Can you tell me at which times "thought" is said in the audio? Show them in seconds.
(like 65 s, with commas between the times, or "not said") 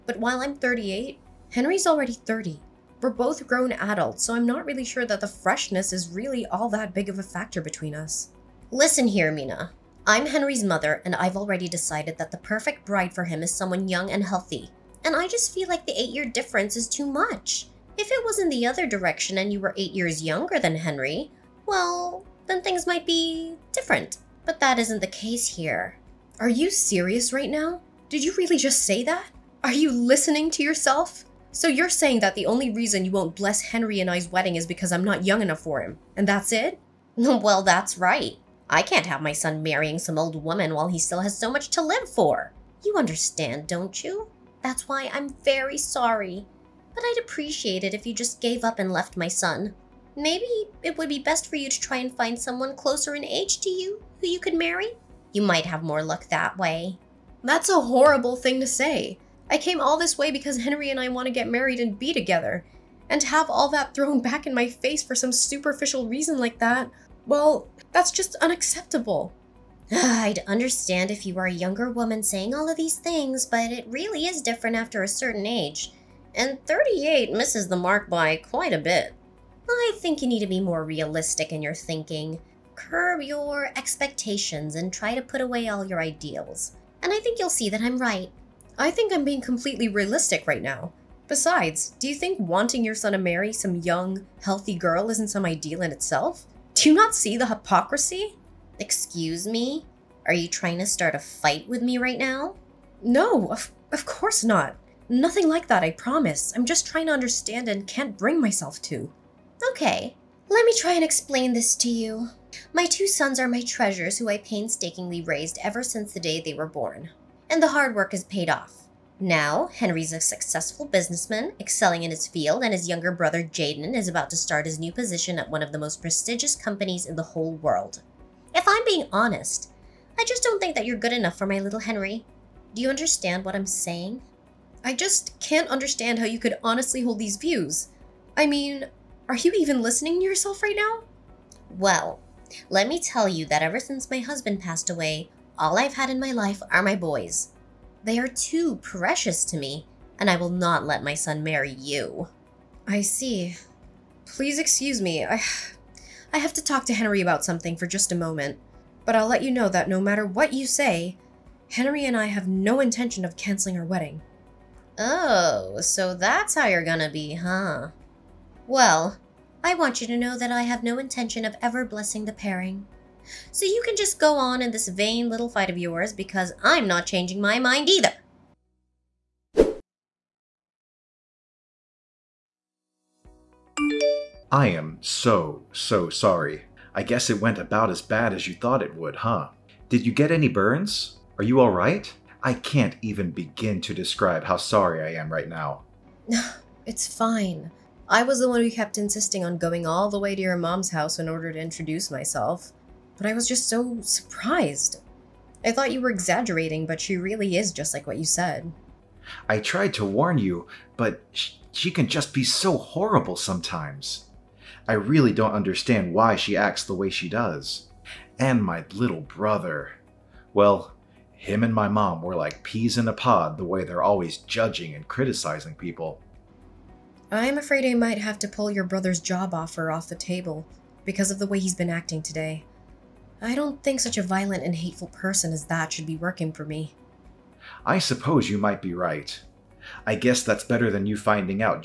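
188 s, 205 s.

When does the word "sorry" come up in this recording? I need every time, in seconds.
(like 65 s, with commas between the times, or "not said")
45 s, 186 s, 194 s.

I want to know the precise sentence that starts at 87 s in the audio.
And I think you'll see that I'm right.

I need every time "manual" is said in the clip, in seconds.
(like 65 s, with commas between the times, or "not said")
not said.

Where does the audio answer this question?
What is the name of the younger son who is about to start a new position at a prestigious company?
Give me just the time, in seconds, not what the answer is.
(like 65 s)
123 s.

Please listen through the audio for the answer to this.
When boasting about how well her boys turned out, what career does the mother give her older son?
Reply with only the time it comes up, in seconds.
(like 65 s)
120 s.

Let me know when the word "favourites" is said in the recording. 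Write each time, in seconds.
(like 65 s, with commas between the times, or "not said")
not said.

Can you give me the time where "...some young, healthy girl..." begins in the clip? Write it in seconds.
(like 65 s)
93 s.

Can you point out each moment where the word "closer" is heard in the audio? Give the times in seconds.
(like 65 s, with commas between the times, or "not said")
52 s.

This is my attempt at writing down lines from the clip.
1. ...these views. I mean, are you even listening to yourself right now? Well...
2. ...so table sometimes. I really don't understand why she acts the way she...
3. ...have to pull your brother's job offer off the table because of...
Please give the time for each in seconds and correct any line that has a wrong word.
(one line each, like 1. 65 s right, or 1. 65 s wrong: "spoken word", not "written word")
1. 137 s right
2. 212 s wrong: "horrible", not "table"
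3. 228 s right.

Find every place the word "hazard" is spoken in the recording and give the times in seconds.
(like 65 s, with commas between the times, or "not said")
not said.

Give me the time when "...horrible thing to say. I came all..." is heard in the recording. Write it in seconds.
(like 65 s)
57 s.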